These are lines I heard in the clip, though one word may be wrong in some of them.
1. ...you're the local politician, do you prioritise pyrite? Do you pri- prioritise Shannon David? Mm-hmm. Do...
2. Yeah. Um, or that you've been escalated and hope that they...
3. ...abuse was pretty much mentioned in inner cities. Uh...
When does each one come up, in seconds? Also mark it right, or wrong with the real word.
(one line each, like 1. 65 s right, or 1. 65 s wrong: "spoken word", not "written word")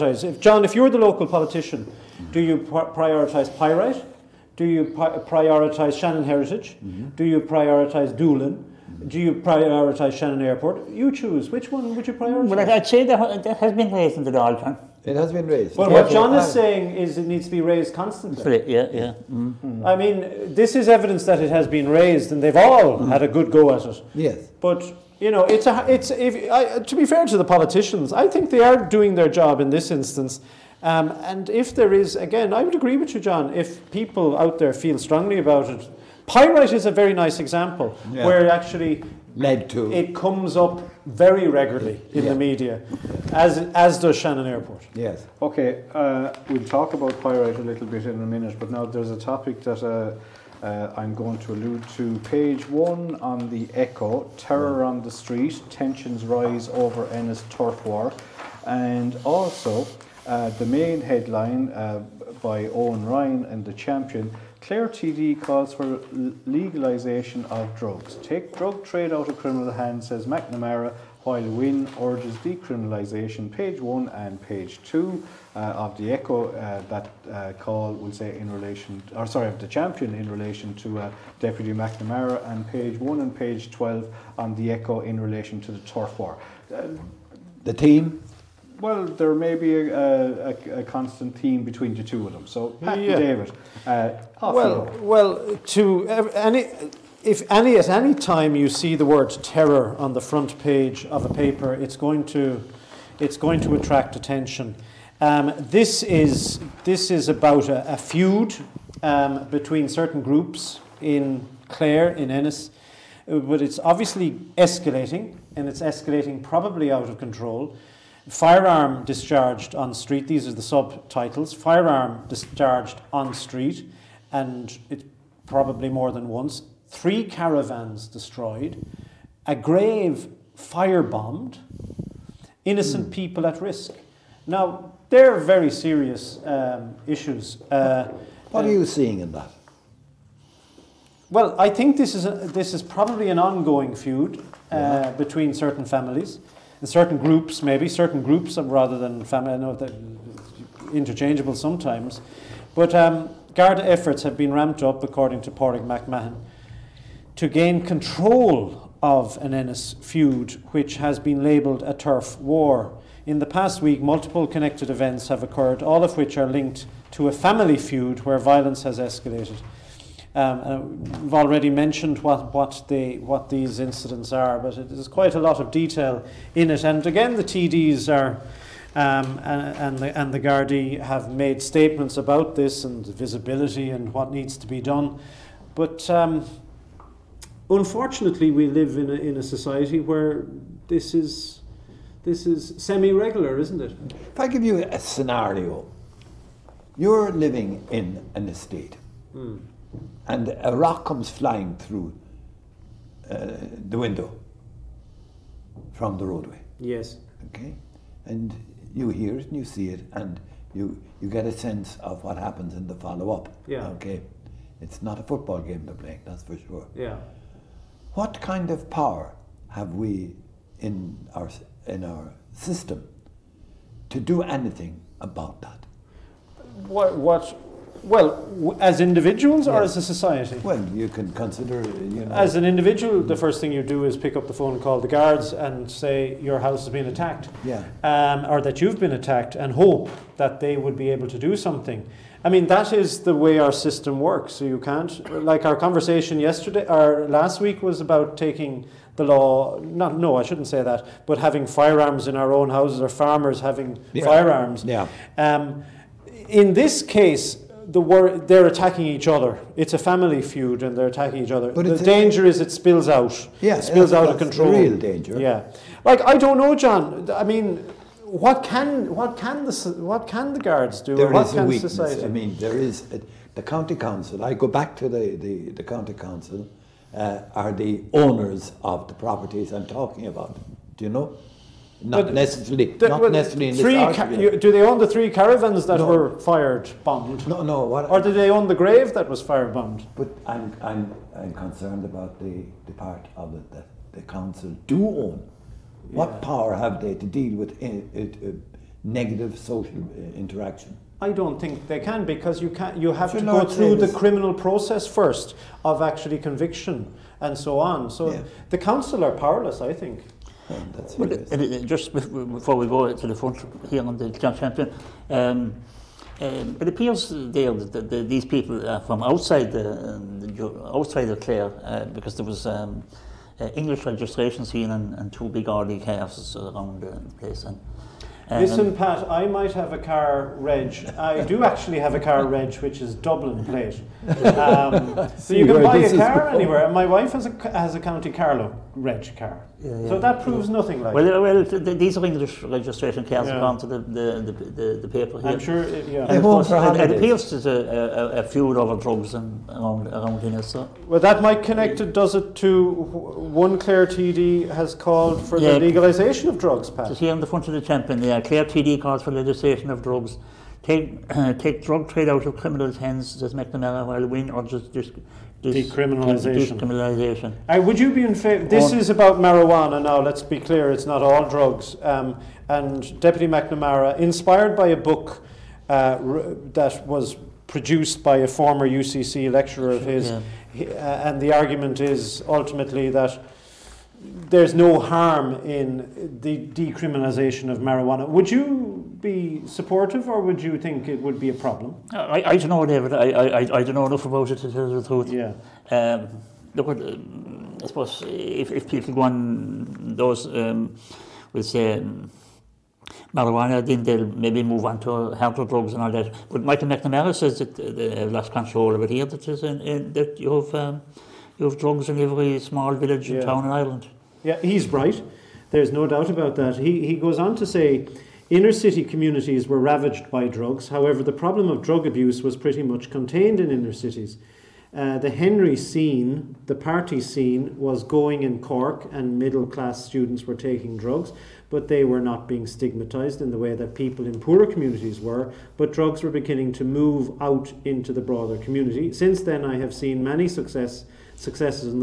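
1. 0 s wrong: "Heritage", not "David"
2. 237 s wrong: "attacked", not "escalated"
3. 422 s wrong: "contained", not "mentioned".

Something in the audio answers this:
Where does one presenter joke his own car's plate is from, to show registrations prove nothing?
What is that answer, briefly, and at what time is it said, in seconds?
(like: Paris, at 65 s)
Dublin, at 333 s.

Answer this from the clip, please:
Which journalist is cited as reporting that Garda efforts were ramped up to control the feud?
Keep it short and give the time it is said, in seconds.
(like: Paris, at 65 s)
Páraic McMahon, at 155 s.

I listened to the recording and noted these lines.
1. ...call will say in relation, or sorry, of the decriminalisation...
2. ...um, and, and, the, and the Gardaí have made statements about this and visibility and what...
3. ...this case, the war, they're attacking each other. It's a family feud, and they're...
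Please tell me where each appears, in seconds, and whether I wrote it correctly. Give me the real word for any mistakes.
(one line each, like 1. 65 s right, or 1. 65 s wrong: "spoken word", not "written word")
1. 77 s wrong: "champion", not "decriminalisation"
2. 178 s right
3. 256 s right.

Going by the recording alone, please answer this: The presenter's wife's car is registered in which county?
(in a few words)
Carlow.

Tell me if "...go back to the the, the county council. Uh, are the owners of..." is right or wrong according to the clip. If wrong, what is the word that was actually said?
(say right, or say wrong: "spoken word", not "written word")
right.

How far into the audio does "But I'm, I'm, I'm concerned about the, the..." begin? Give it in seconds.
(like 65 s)
290 s.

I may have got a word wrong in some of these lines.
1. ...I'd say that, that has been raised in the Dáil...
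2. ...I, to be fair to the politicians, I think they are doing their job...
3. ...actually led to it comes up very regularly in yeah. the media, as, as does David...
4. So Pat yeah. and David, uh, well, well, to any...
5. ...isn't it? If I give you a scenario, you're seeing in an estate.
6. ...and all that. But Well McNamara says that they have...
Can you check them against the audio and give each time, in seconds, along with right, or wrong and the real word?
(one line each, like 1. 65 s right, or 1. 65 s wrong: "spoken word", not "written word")
1. 12 s right
2. 26 s right
3. 38 s wrong: "Shannon", not "David"
4. 92 s right
5. 193 s wrong: "living", not "seeing"
6. 405 s wrong: "Michael", not "Well".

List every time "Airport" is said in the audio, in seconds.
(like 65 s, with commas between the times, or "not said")
10 s, 44 s.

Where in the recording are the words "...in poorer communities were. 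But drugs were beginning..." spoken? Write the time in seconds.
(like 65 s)
434 s.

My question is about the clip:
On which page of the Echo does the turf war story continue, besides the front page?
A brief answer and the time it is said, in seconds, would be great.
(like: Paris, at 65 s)
Page 12, at 83 s.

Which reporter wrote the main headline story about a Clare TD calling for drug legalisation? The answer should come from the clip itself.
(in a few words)
Owen Ryan.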